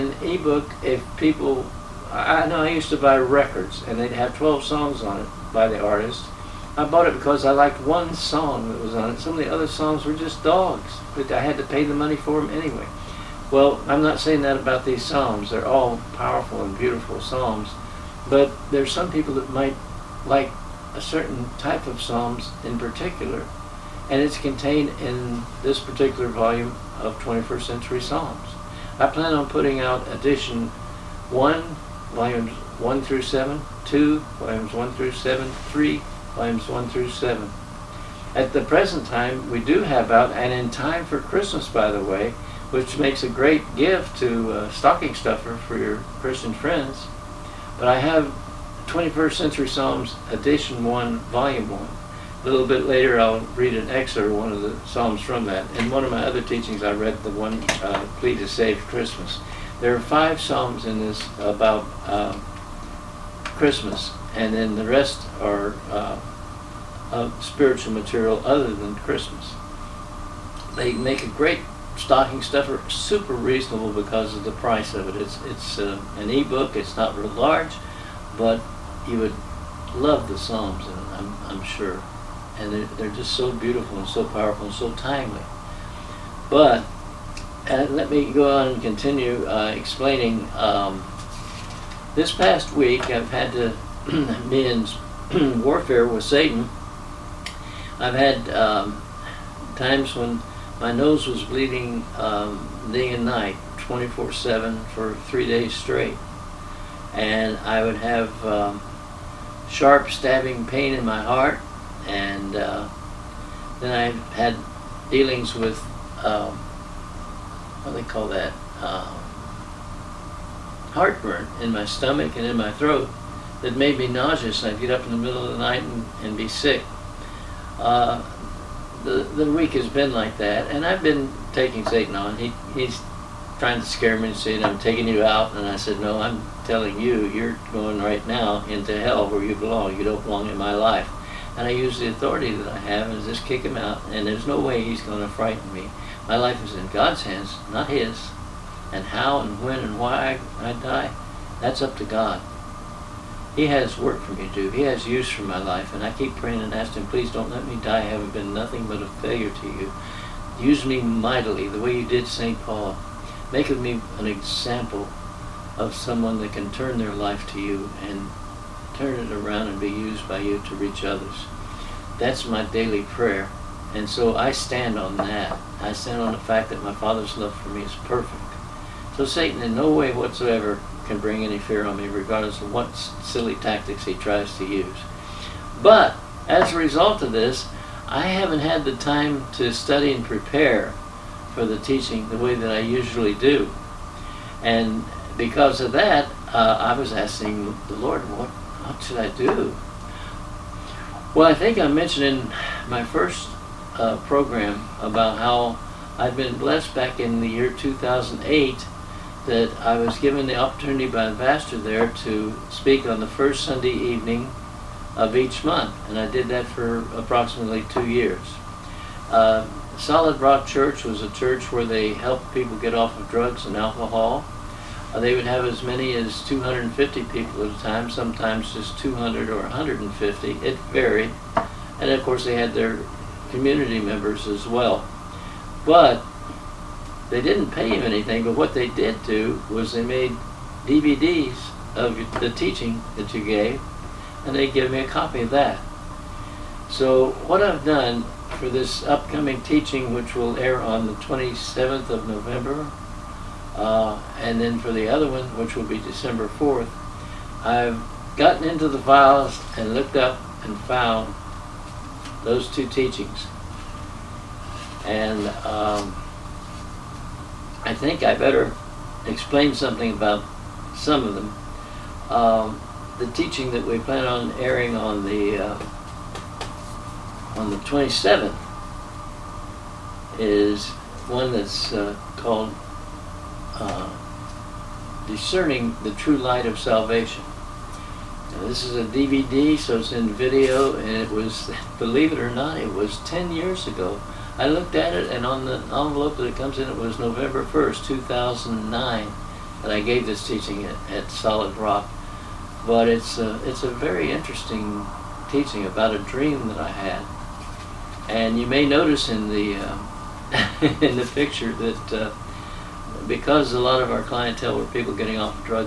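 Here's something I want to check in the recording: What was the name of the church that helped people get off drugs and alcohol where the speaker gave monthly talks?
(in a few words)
Solid Rock Church.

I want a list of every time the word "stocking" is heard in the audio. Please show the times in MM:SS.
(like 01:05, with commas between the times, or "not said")
00:44, 01:11.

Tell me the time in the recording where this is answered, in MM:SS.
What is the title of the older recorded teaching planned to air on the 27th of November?
04:45.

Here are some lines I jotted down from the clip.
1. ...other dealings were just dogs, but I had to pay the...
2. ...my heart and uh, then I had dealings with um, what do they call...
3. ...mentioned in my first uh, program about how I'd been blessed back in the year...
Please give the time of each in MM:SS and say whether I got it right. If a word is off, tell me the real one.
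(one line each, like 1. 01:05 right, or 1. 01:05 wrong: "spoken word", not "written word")
1. 00:09 wrong: "songs", not "dealings"
2. 01:51 right
3. 03:21 right.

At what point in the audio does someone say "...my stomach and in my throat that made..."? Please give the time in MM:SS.
02:01.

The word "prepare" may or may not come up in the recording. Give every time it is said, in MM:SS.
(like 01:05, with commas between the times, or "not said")
03:10.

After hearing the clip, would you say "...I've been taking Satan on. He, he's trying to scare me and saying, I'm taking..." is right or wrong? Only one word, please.
right.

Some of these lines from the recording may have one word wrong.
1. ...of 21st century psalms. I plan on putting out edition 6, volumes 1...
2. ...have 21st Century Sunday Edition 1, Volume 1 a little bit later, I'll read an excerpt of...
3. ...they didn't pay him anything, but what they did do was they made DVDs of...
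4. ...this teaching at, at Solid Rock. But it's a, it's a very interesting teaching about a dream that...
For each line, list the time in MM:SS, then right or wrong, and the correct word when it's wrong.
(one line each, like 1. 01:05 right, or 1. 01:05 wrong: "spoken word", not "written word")
1. 00:26 wrong: "1", not "6"
2. 00:47 wrong: "Psalms", not "Sunday"
3. 03:57 right
4. 05:00 right.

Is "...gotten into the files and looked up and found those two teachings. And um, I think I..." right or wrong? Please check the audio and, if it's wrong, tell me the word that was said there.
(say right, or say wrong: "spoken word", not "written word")
right.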